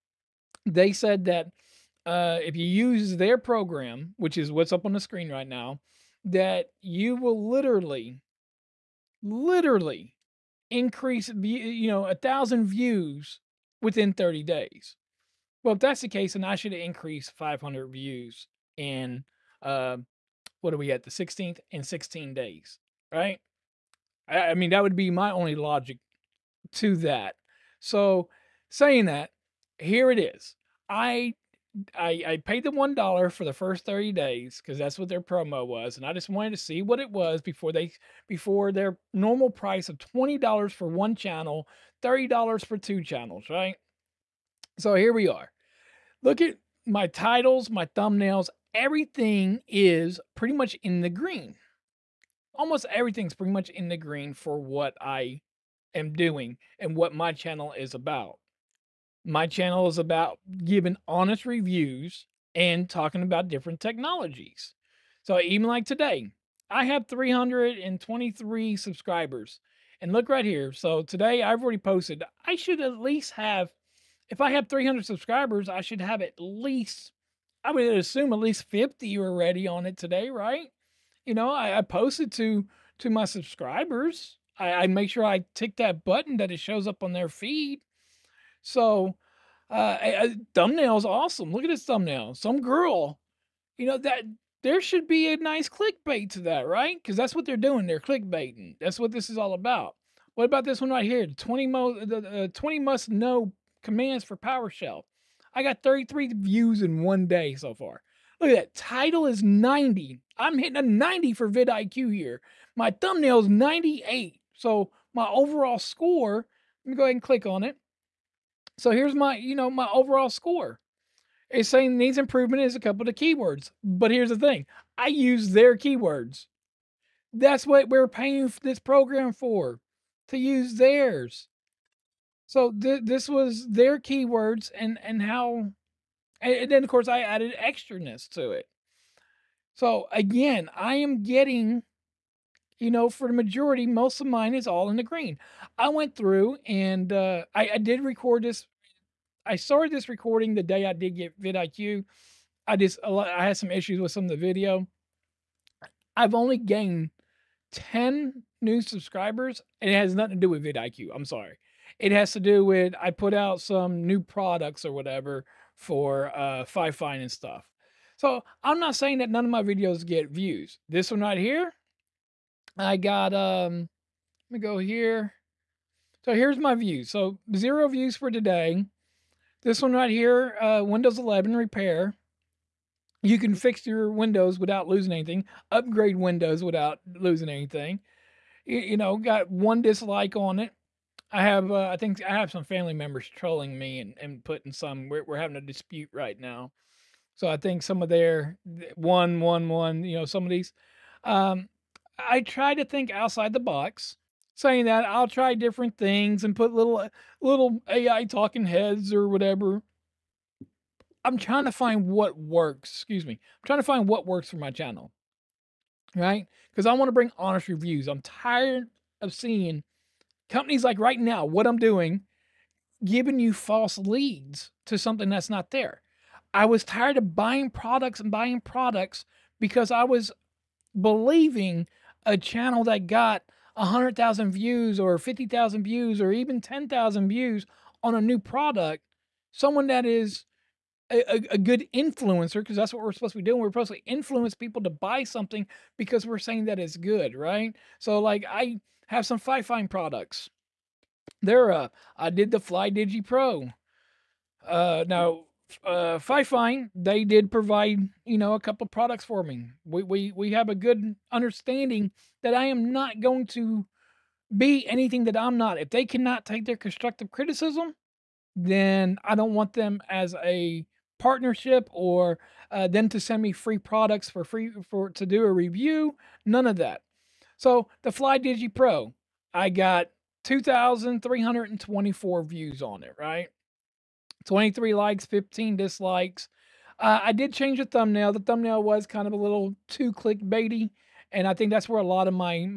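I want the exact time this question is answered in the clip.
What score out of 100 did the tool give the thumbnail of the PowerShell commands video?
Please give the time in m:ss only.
1:53.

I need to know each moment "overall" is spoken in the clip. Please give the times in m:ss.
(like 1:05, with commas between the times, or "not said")
1:55, 1:59.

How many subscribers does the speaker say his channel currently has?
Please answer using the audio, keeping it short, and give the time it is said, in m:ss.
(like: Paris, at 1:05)
323, at 1:07.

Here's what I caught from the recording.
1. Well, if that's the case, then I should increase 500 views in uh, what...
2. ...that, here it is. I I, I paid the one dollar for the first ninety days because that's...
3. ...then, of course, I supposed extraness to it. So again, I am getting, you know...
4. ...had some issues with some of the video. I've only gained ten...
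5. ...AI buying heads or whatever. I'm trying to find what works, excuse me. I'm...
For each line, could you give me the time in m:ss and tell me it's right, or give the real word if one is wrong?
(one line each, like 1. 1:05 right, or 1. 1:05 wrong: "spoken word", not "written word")
1. 0:15 right
2. 0:29 wrong: "thirty", not "ninety"
3. 2:16 wrong: "added", not "supposed"
4. 2:33 right
5. 3:27 wrong: "talking", not "buying".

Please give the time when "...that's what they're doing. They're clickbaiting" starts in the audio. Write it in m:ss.
1:37.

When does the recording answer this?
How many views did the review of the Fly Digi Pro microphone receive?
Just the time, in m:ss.
4:40.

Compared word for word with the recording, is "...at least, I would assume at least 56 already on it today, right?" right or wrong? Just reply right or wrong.
wrong.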